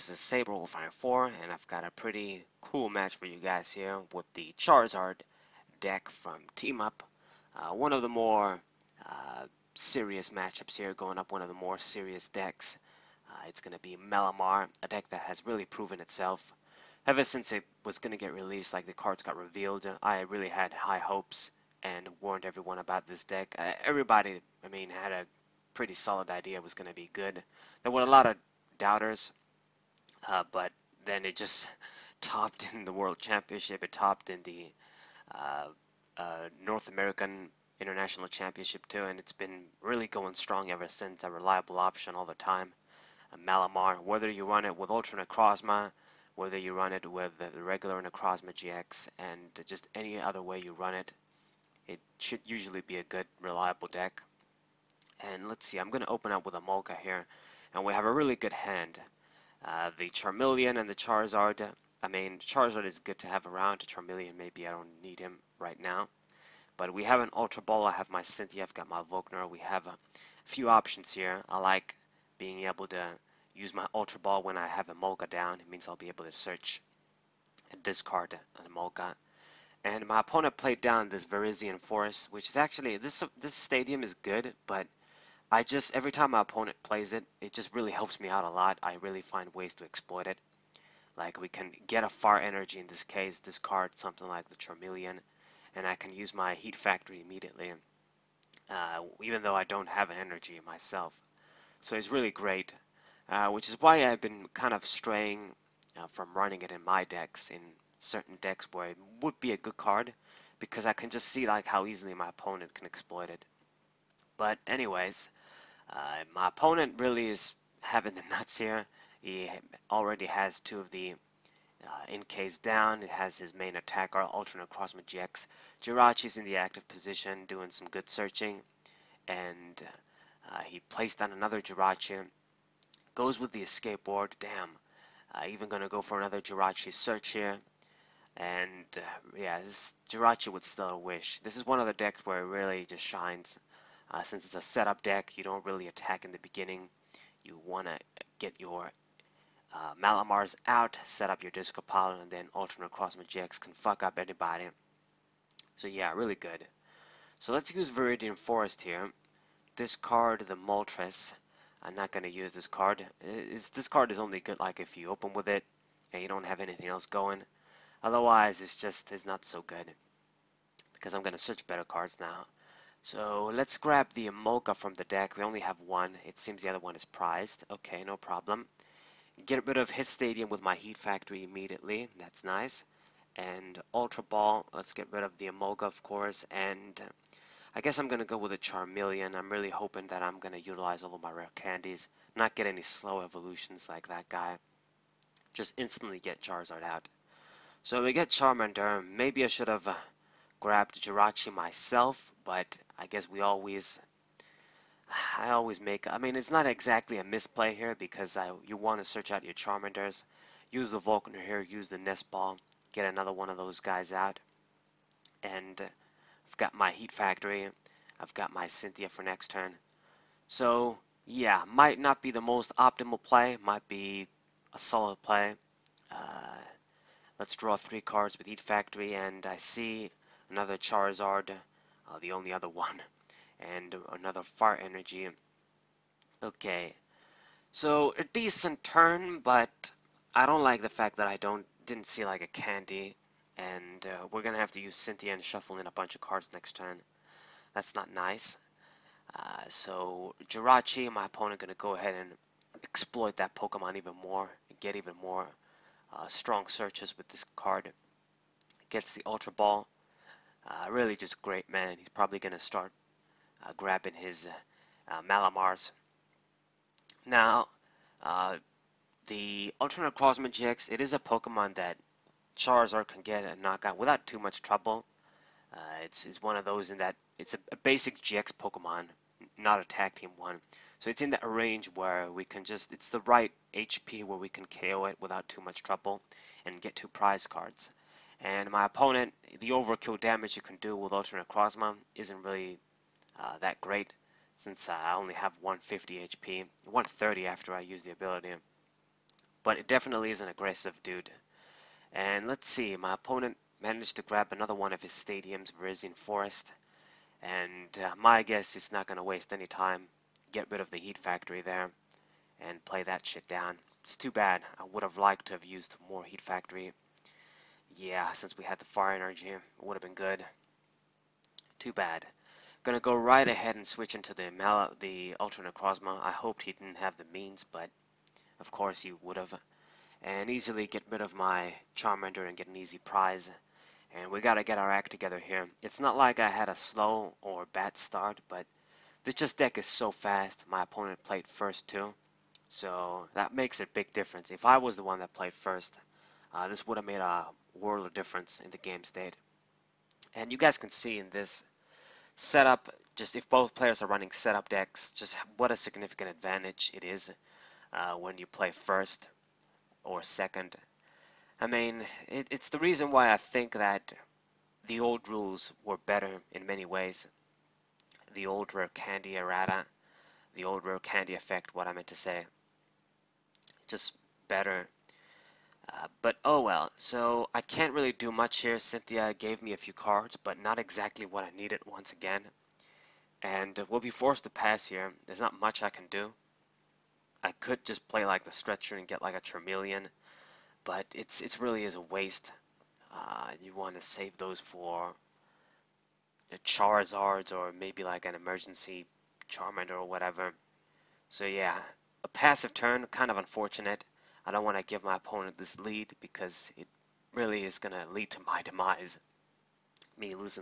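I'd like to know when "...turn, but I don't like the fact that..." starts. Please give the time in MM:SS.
03:58.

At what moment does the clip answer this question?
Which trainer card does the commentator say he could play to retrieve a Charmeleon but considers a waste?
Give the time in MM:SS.
06:28.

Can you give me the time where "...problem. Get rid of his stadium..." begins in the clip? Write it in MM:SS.
02:58.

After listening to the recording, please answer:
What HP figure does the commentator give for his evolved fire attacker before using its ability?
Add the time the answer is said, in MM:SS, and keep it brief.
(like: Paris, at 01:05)
150, at 04:55.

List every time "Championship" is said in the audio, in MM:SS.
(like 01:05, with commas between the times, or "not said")
00:33, 00:38.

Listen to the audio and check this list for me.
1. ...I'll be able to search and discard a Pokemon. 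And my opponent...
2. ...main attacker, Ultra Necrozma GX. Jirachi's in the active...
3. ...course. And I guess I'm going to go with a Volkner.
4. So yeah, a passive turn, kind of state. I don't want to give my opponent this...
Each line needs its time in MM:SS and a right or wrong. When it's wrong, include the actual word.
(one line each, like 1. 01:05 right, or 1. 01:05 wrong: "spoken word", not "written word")
1. 01:15 wrong: "Emolga", not "Pokemon"
2. 02:03 right
3. 03:06 wrong: "Charmeleon", not "Volkner"
4. 06:41 wrong: "unfortunate", not "state".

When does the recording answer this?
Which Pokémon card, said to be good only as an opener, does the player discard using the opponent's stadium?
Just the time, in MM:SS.
02:40.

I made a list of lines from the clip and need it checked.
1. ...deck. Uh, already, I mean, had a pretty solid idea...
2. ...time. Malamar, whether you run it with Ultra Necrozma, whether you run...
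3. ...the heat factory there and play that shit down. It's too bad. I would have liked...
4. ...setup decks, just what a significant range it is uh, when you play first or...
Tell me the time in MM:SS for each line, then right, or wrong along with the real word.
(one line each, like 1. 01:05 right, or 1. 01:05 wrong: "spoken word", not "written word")
1. 00:23 wrong: "everybody", not "already"
2. 00:42 right
3. 05:10 right
4. 05:54 wrong: "advantage", not "range".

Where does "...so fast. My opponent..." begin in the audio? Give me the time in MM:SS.
05:39.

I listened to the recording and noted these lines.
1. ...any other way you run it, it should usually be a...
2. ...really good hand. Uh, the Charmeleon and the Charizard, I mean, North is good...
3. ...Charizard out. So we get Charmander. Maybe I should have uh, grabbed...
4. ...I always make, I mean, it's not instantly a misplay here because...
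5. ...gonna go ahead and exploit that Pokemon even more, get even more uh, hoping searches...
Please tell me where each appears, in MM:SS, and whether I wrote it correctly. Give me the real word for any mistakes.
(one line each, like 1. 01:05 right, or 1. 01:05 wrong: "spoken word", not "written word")
1. 00:49 right
2. 00:58 wrong: "Charizard", not "North"
3. 03:16 right
4. 03:25 wrong: "exactly", not "instantly"
5. 04:11 wrong: "strong", not "hoping".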